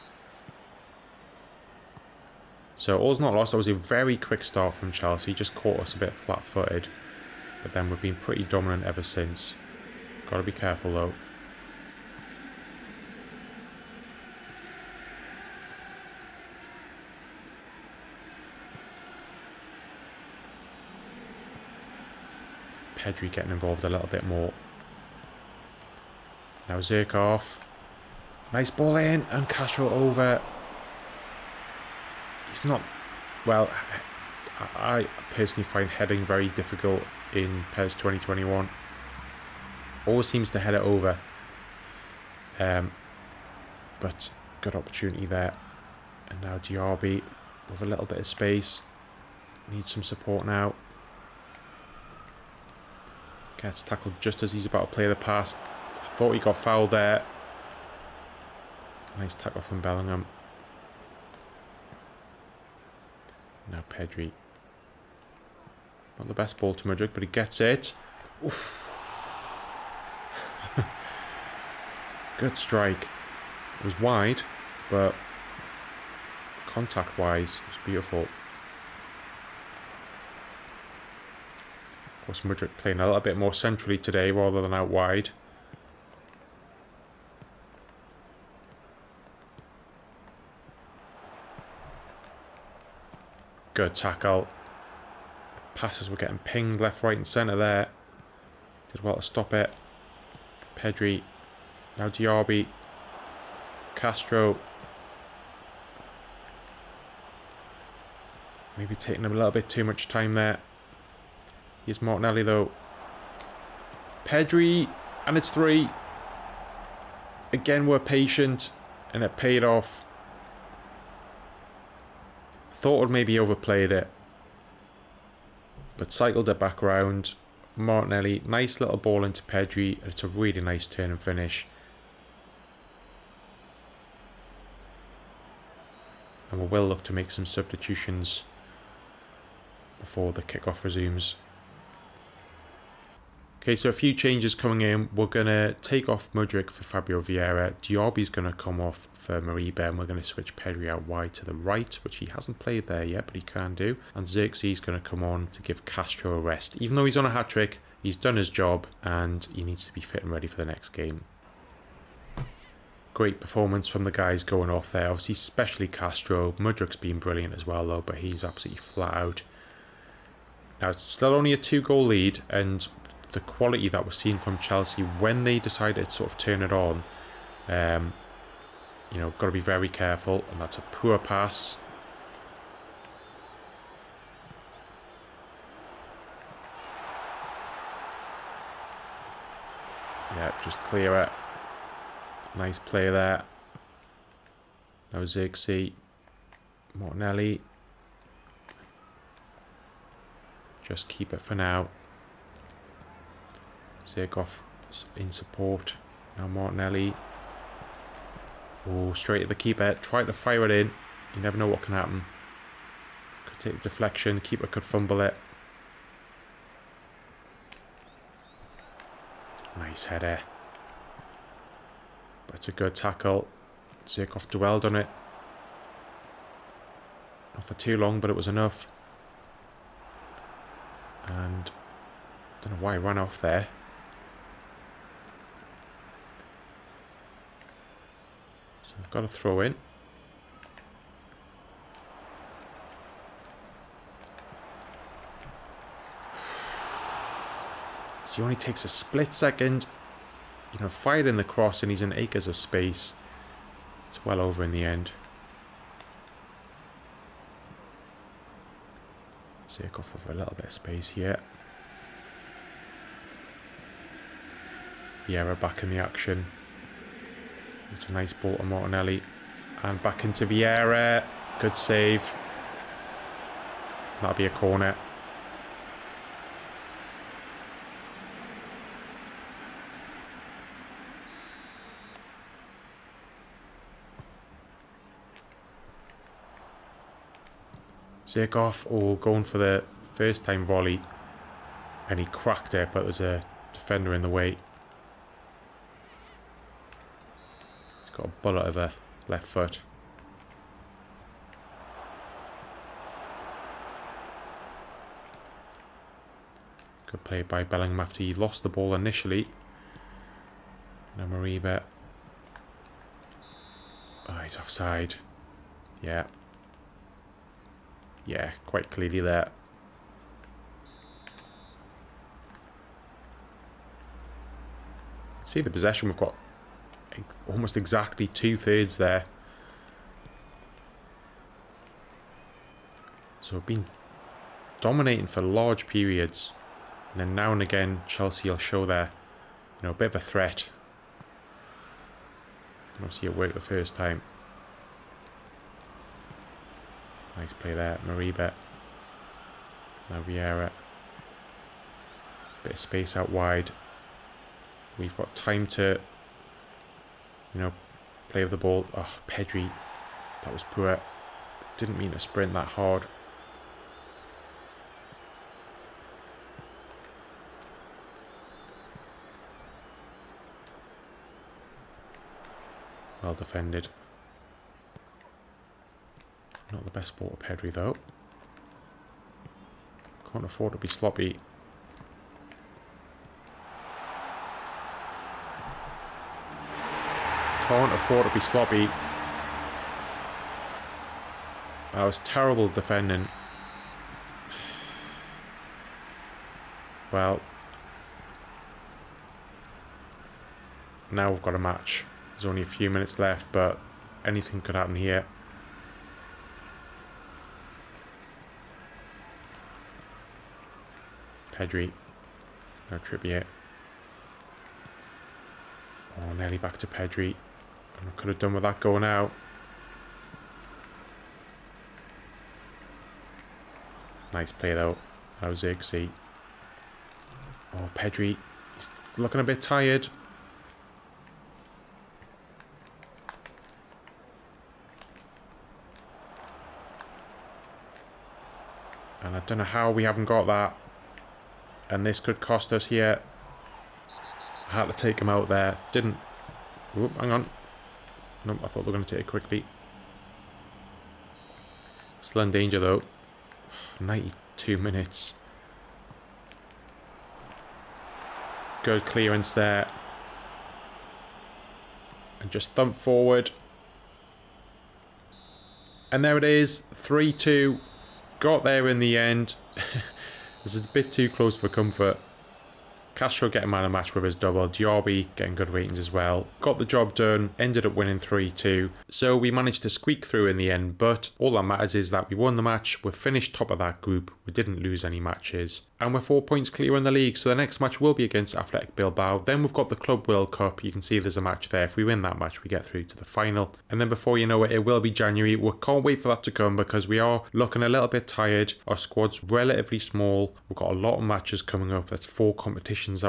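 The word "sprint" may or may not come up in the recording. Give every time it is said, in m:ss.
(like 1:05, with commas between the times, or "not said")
6:02.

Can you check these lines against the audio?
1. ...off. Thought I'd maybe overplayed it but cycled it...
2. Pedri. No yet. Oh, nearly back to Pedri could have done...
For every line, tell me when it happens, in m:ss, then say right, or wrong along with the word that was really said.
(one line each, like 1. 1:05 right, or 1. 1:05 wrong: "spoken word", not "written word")
1. 1:59 right
2. 6:51 right.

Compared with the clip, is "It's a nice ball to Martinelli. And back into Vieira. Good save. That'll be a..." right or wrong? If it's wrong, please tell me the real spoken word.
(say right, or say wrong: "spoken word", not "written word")
right.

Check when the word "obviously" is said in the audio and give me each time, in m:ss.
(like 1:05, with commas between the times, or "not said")
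2:45, 5:43.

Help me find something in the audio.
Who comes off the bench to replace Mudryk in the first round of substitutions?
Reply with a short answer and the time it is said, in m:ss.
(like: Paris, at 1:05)
Fabio Vieira, at 2:26.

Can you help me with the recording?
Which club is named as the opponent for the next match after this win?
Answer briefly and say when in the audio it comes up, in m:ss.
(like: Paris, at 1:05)
Athletic Bilbao, at 8:08.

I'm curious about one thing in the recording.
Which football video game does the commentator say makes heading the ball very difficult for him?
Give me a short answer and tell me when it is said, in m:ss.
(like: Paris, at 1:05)
PES 2021, at 0:37.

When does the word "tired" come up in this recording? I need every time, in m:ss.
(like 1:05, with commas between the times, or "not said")
7:09, 8:18.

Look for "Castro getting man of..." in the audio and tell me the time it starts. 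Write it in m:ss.
7:53.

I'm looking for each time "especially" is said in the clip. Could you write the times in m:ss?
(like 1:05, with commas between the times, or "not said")
2:45.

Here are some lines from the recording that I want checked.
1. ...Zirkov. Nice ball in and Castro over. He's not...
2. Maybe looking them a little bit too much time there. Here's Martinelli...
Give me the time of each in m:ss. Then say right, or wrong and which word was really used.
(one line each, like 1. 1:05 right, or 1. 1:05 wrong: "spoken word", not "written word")
1. 0:26 right
2. 1:48 wrong: "taking", not "looking".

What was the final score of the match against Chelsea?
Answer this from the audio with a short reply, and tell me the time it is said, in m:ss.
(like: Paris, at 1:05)
3-2, at 7:46.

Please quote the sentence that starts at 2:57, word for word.
Um, you know, got to be very careful, and that's a poor pass.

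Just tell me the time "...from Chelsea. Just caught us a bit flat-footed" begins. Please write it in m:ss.
0:04.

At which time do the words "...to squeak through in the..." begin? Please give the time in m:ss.
7:59.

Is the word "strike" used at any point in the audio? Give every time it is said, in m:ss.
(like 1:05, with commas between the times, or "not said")
1:12.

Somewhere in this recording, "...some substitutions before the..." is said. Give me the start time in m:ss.
2:17.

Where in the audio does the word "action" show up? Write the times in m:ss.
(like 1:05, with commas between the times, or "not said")
4:25.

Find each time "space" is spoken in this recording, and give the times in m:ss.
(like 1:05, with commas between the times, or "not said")
0:48, 4:12, 4:20, 5:52.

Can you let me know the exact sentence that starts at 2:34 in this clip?
And Zirkzee going to come on to give Castro a rest.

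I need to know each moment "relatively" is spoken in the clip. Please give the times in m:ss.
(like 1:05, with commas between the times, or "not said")
8:19.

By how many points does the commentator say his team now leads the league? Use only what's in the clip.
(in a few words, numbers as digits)
4.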